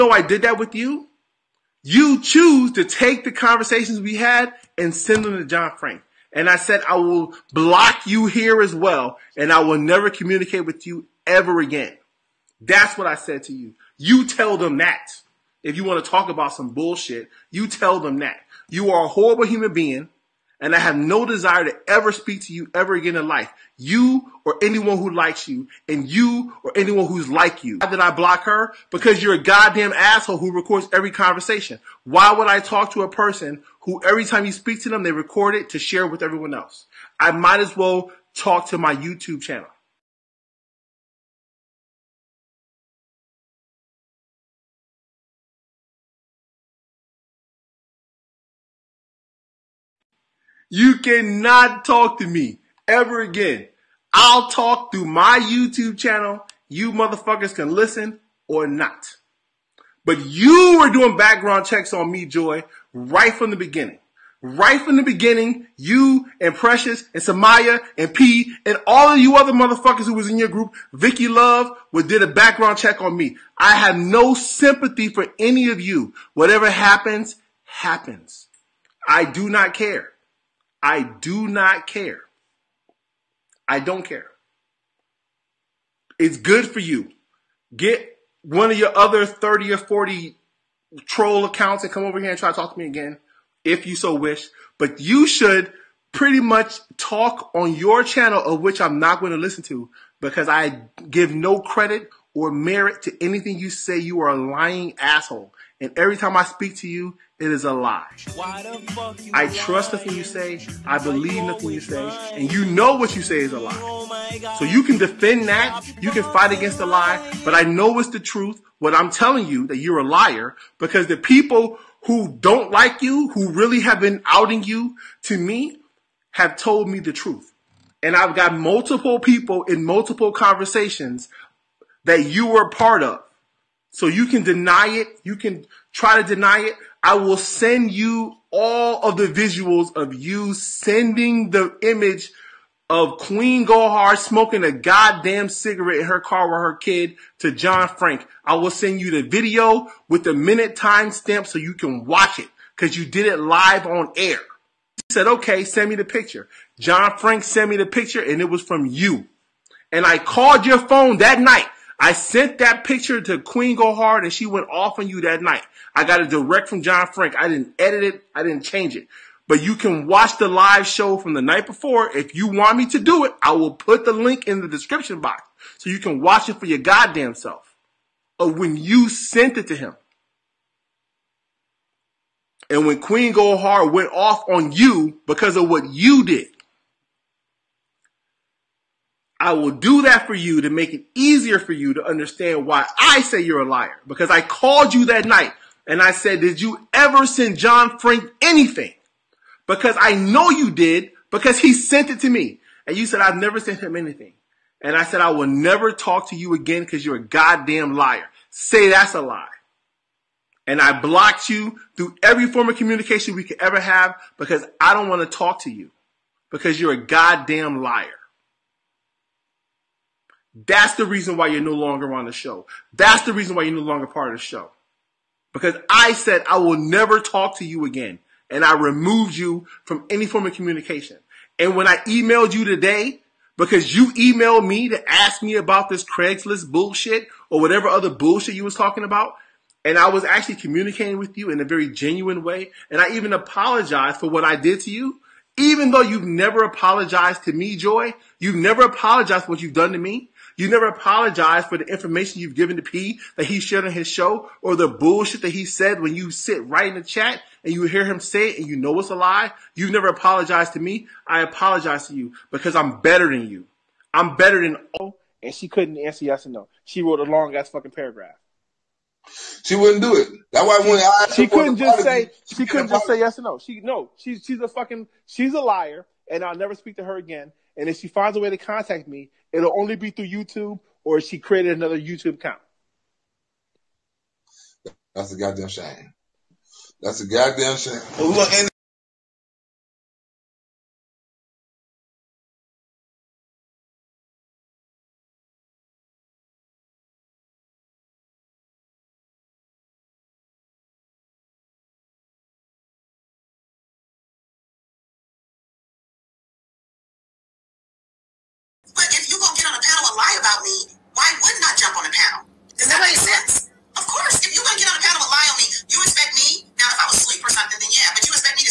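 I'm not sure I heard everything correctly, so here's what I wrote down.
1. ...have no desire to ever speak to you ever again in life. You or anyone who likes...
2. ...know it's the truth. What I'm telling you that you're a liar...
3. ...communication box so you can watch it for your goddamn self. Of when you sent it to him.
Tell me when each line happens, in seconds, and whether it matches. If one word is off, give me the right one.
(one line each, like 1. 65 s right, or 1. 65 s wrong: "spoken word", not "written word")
1. 20 s right
2. 117 s right
3. 174 s wrong: "description", not "communication".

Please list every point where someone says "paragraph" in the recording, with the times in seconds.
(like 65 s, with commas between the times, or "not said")
267 s.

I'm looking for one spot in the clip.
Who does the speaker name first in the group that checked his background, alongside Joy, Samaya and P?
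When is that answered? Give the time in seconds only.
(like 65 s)
66 s.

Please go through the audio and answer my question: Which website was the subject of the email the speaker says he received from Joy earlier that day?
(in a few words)
Craigslist.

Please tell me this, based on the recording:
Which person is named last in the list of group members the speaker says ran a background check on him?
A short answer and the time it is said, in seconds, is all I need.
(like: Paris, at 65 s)
Vicky Love, at 70 s.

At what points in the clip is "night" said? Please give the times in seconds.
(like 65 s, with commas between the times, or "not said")
161 s, 165 s, 171 s, 195 s.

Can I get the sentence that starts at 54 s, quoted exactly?
I'll talk through my YouTube channel.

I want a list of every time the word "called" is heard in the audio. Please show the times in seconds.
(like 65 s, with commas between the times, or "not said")
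160 s, 194 s.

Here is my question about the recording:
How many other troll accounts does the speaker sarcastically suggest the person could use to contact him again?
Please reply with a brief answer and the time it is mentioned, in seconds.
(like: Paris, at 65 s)
30 or 40, at 89 s.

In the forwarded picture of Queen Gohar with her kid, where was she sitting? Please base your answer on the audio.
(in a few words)
her car.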